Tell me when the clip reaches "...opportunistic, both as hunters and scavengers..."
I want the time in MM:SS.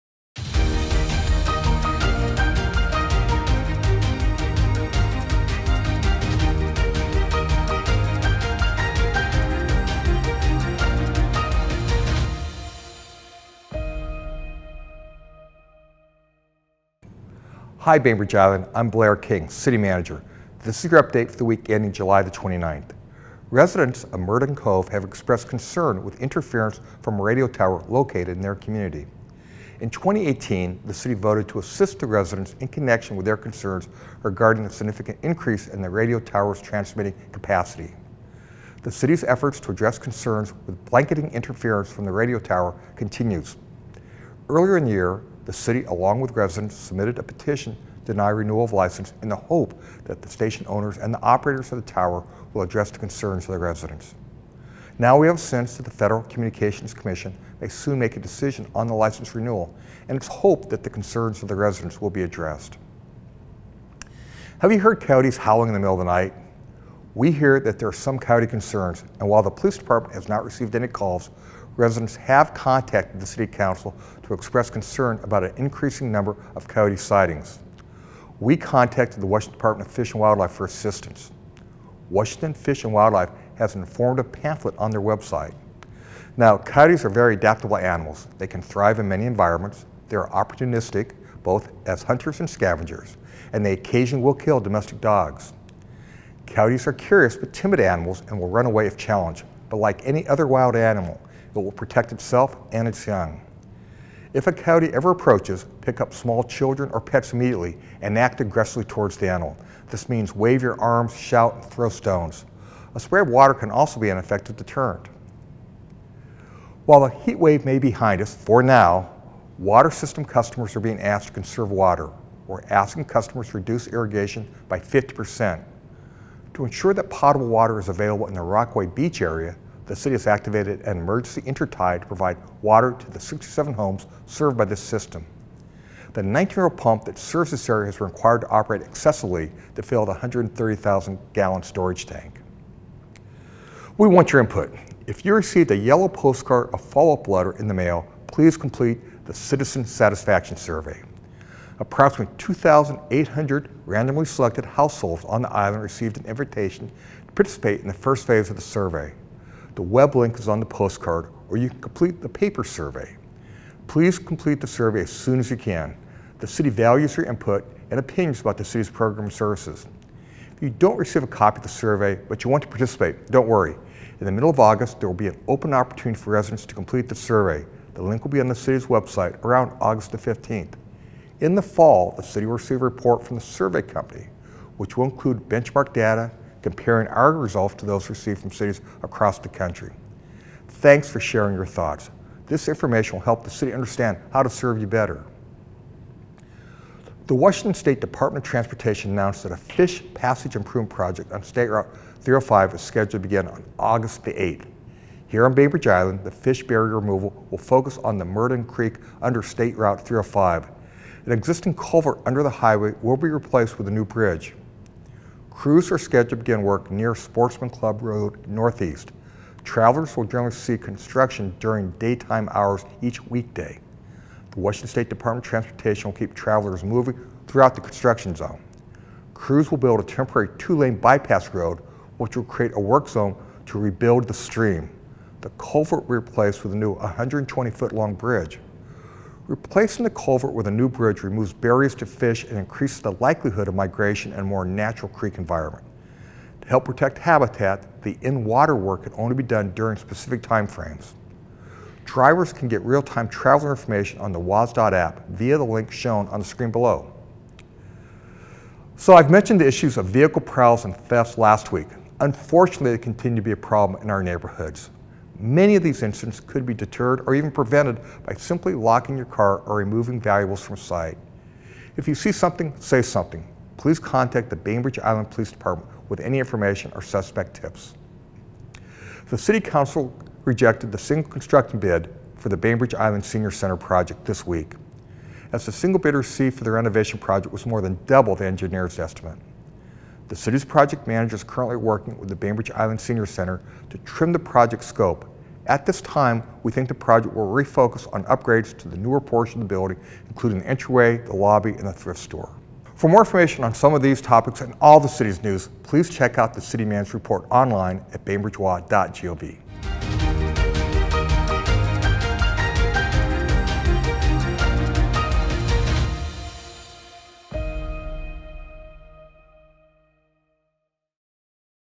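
01:30.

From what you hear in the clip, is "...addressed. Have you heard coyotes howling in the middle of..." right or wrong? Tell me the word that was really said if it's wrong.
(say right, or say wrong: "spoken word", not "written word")
right.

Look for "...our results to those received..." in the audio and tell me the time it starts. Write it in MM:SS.
03:07.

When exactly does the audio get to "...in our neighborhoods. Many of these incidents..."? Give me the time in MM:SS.
04:24.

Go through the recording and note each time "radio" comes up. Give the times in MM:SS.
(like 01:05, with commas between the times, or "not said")
00:27, 00:35, 00:42.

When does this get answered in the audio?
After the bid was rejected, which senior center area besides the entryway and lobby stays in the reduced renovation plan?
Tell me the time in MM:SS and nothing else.
05:01.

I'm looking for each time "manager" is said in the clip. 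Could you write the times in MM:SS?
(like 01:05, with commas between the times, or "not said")
00:19, 04:51, 05:06.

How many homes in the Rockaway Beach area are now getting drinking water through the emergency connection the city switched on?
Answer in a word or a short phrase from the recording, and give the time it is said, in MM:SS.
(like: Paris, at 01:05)
67, at 02:13.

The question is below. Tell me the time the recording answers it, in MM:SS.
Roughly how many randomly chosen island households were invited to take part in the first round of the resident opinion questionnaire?
02:32.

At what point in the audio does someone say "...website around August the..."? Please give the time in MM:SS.
02:58.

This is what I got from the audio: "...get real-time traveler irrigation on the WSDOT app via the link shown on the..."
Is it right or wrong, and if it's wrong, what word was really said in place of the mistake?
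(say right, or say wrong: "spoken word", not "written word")
wrong: "information", not "irrigation".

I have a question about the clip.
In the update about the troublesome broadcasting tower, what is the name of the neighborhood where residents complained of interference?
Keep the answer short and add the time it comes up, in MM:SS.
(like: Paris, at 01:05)
Murden Cove, at 00:24.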